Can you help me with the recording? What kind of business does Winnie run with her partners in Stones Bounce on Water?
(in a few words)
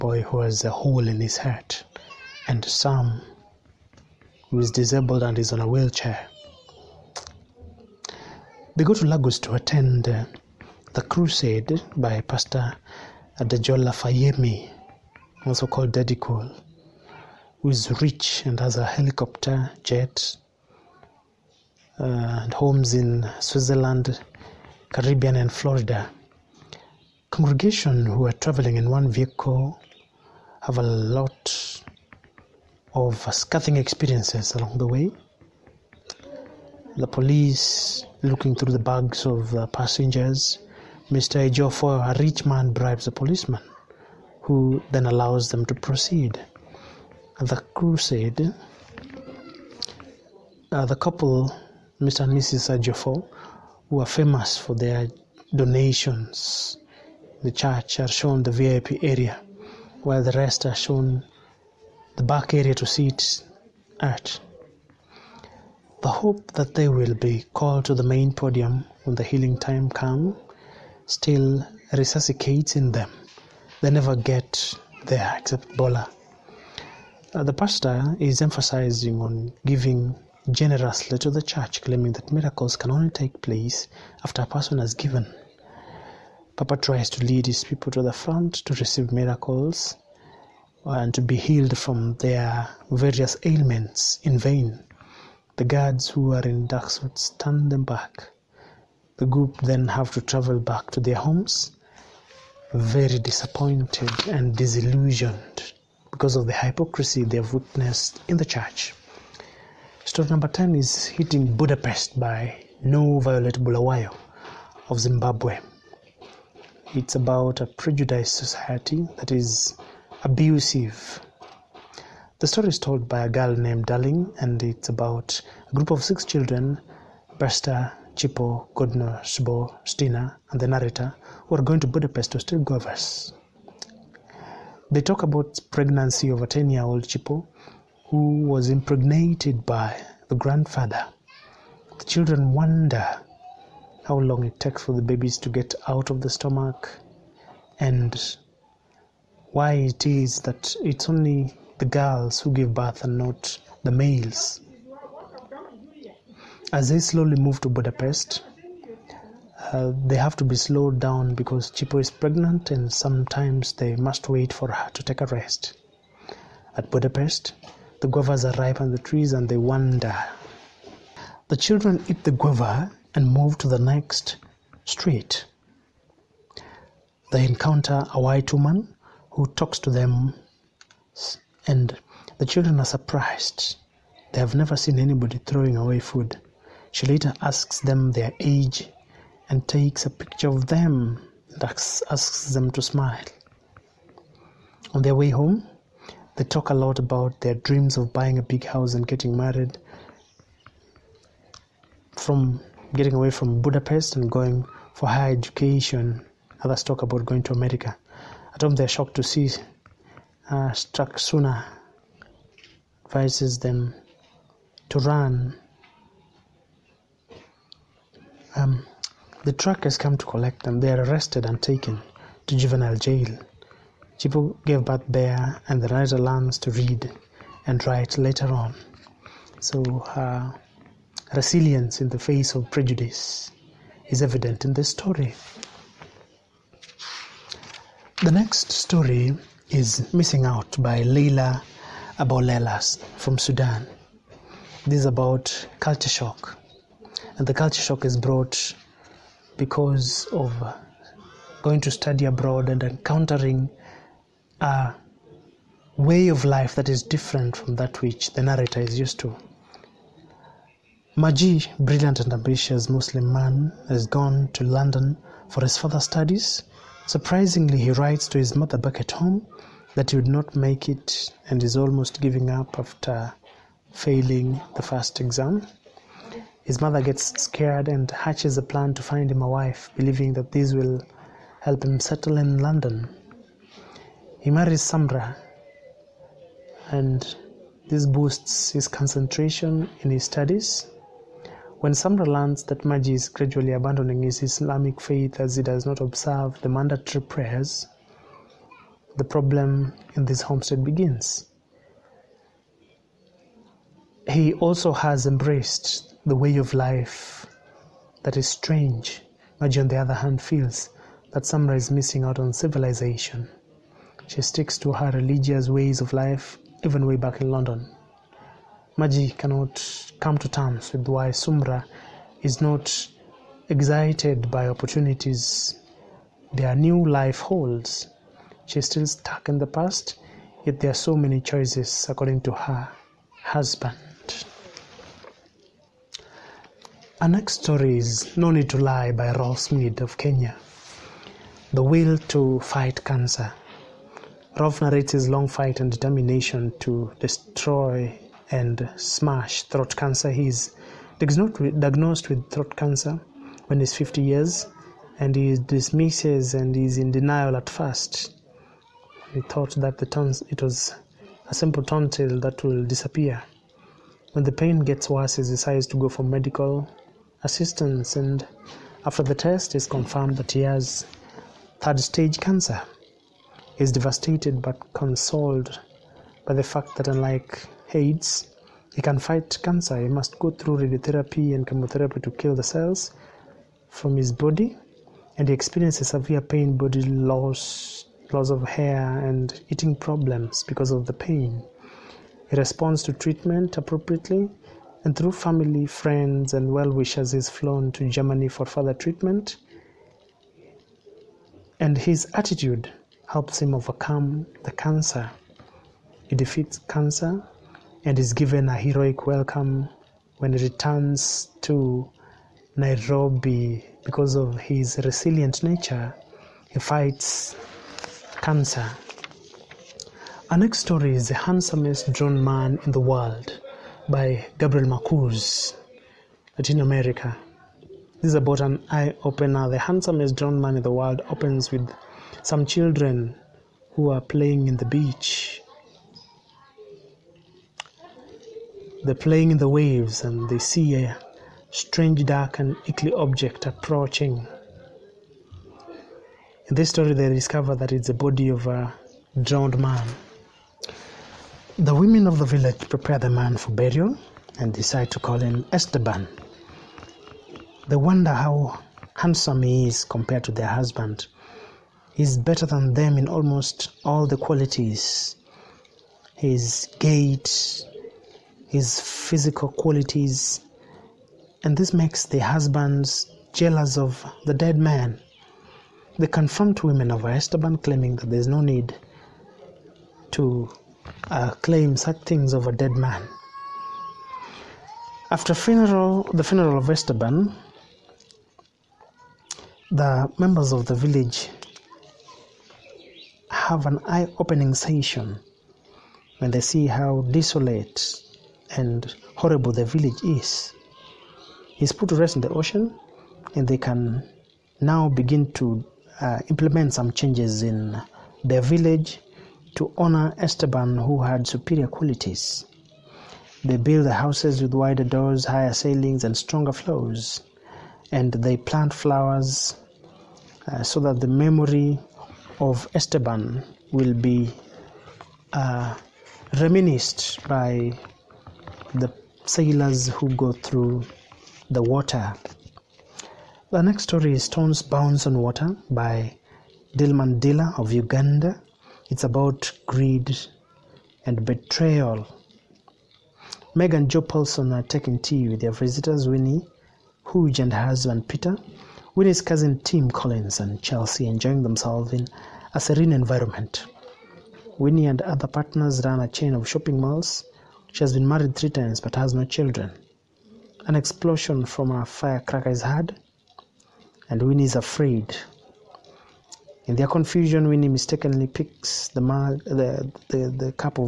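shopping malls.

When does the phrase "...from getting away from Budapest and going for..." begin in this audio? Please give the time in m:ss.
3:22.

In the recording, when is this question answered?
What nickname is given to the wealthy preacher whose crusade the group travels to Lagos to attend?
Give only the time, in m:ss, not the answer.
0:15.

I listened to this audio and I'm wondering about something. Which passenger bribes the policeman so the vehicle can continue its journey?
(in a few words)
Mr. Ejofo.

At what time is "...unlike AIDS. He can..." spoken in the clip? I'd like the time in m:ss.
6:17.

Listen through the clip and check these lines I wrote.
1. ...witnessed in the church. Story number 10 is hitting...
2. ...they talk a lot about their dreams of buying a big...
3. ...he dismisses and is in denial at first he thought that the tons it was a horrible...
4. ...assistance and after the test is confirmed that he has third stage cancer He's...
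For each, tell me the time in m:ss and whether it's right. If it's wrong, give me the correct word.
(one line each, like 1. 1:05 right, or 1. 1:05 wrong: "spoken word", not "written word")
1. 1:47 right
2. 3:16 right
3. 5:55 wrong: "simple", not "horrible"
4. 6:07 right.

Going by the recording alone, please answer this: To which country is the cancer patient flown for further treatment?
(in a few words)
Germany.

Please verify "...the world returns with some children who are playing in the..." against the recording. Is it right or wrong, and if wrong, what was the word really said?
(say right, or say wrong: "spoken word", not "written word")
wrong: "opens", not "returns".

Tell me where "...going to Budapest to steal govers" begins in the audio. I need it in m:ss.
2:11.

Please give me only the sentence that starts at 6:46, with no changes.
He defeats cancer and is given a heroic welcome when he returns to Nairobi because of his resilient nature.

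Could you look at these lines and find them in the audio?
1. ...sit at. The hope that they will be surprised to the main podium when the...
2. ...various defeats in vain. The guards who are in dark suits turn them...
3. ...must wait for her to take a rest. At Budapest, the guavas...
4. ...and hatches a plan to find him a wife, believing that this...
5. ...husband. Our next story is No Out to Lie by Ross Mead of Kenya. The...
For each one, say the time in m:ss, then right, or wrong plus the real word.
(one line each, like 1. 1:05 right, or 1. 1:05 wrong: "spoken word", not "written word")
1. 1:02 wrong: "called", not "surprised"
2. 1:32 wrong: "ailments", not "defeats"
3. 2:43 right
4. 4:37 right
5. 5:33 wrong: "Need", not "Out".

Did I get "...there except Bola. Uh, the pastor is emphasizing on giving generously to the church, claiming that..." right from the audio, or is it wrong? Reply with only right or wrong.
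right.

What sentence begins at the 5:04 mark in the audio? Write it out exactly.
He also has embraced the way of life that is strange.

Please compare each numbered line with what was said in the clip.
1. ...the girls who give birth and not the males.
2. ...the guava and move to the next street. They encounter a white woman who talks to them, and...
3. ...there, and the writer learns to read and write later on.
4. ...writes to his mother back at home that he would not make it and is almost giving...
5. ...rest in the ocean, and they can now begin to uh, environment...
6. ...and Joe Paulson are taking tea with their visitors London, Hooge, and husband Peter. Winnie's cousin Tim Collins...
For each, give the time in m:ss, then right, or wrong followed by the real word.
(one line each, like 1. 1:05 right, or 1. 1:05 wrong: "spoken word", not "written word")
1. 2:31 right
2. 2:52 right
3. 3:45 right
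4. 4:27 right
5. 8:22 wrong: "implement", not "environment"
6. 9:03 wrong: "Winnie", not "London".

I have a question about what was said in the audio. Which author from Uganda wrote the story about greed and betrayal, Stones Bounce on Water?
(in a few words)
Dilman Dila.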